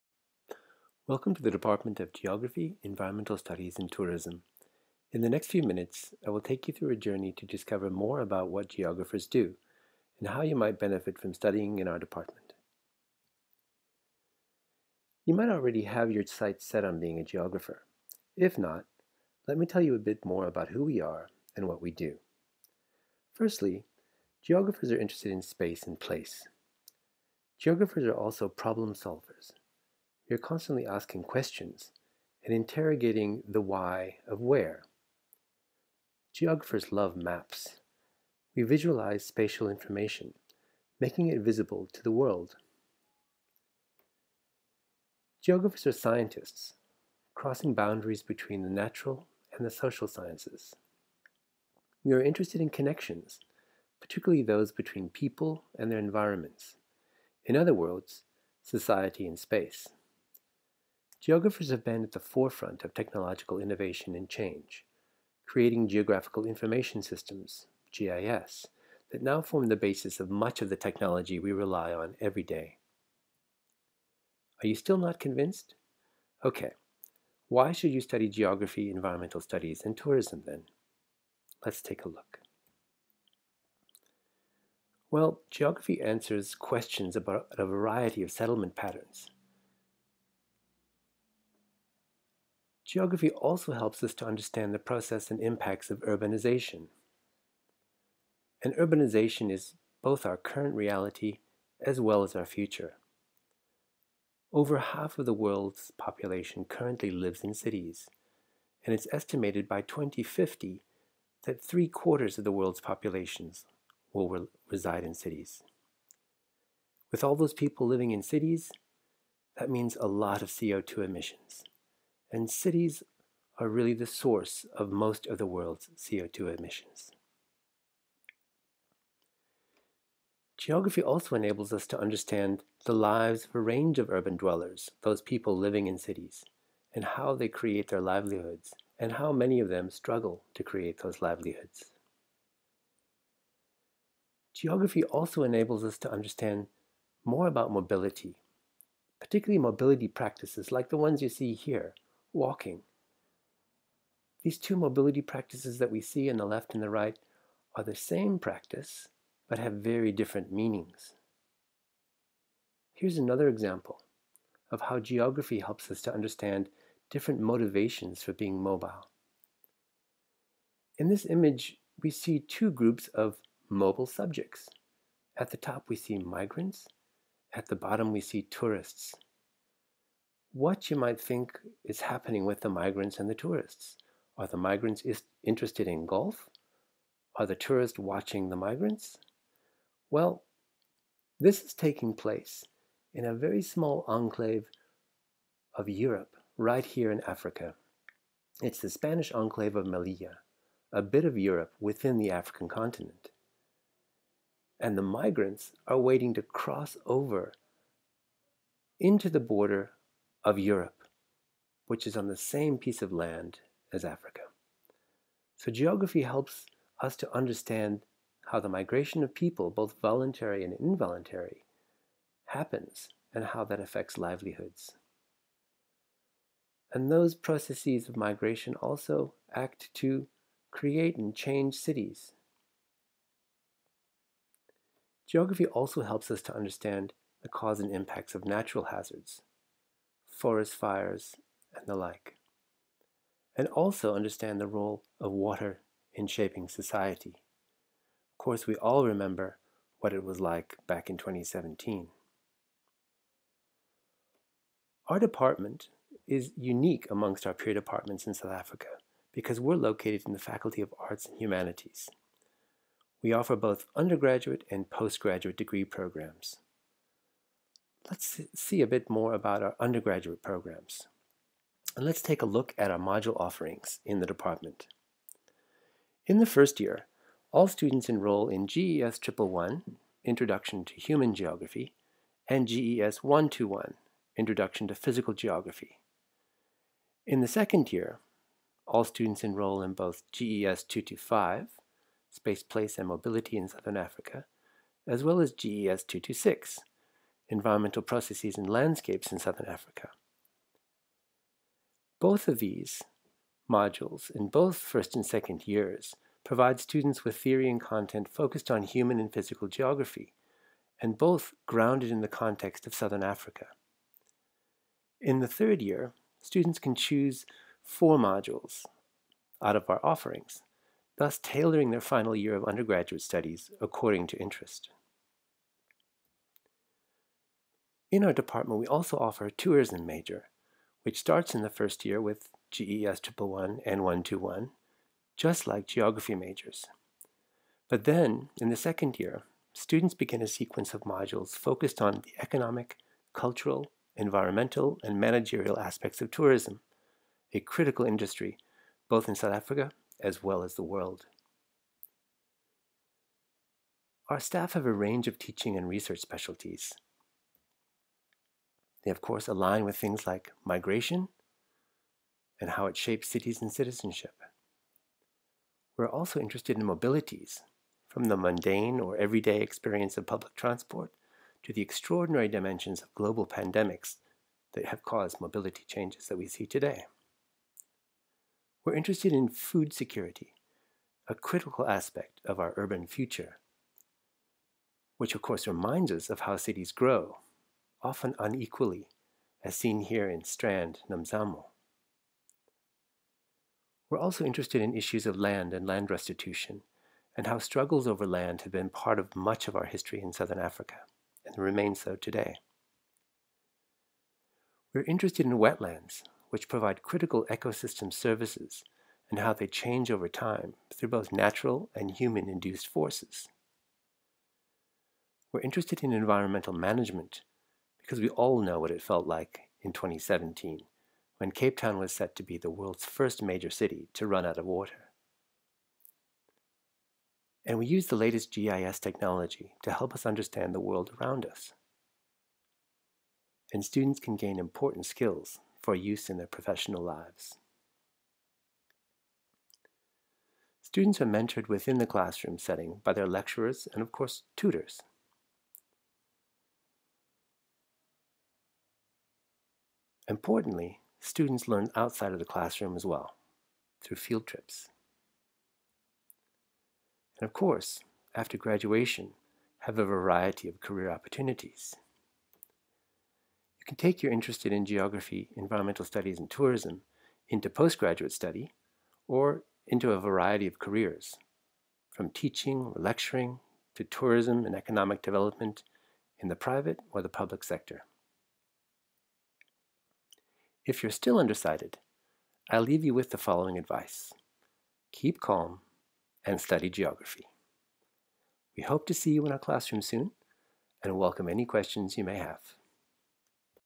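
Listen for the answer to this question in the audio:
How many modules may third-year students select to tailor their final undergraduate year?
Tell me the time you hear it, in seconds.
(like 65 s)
317 s.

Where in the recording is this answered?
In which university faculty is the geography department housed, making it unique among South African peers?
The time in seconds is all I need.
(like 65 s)
260 s.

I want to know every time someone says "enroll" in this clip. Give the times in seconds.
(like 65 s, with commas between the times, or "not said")
278 s, 289 s.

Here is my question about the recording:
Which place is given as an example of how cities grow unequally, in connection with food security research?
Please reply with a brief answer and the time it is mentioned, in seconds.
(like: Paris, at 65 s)
Strand, Nomzamo, at 390 s.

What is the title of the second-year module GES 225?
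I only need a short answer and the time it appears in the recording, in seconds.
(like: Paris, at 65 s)
Space, Place, and Mobility in Southern Africa, at 292 s.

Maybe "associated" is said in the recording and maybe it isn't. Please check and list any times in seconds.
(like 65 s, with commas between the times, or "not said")
not said.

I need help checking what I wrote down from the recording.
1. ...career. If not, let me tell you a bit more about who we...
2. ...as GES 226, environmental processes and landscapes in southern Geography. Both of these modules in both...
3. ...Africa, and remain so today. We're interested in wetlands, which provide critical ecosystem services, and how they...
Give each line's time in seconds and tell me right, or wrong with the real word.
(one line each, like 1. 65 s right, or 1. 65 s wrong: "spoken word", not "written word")
1. 17 s wrong: "geographer", not "career"
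2. 295 s wrong: "Africa", not "Geography"
3. 400 s right.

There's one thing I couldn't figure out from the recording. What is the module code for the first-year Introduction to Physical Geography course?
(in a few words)
GES 121.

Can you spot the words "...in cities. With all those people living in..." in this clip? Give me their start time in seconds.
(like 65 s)
115 s.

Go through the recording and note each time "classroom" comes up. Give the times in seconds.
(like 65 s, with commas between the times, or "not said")
442 s, 452 s, 489 s.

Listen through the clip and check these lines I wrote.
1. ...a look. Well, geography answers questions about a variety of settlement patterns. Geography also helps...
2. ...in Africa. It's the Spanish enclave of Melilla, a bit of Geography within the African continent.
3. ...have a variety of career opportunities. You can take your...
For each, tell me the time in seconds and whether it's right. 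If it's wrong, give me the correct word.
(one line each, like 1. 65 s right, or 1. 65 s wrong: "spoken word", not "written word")
1. 82 s right
2. 197 s wrong: "Europe", not "Geography"
3. 459 s right.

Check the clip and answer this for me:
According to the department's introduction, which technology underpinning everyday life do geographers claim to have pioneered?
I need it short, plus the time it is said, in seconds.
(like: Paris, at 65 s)
Geographical information systems, at 65 s.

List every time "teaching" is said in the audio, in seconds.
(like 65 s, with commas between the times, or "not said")
355 s, 472 s.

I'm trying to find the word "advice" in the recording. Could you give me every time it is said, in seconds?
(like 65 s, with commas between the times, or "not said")
483 s.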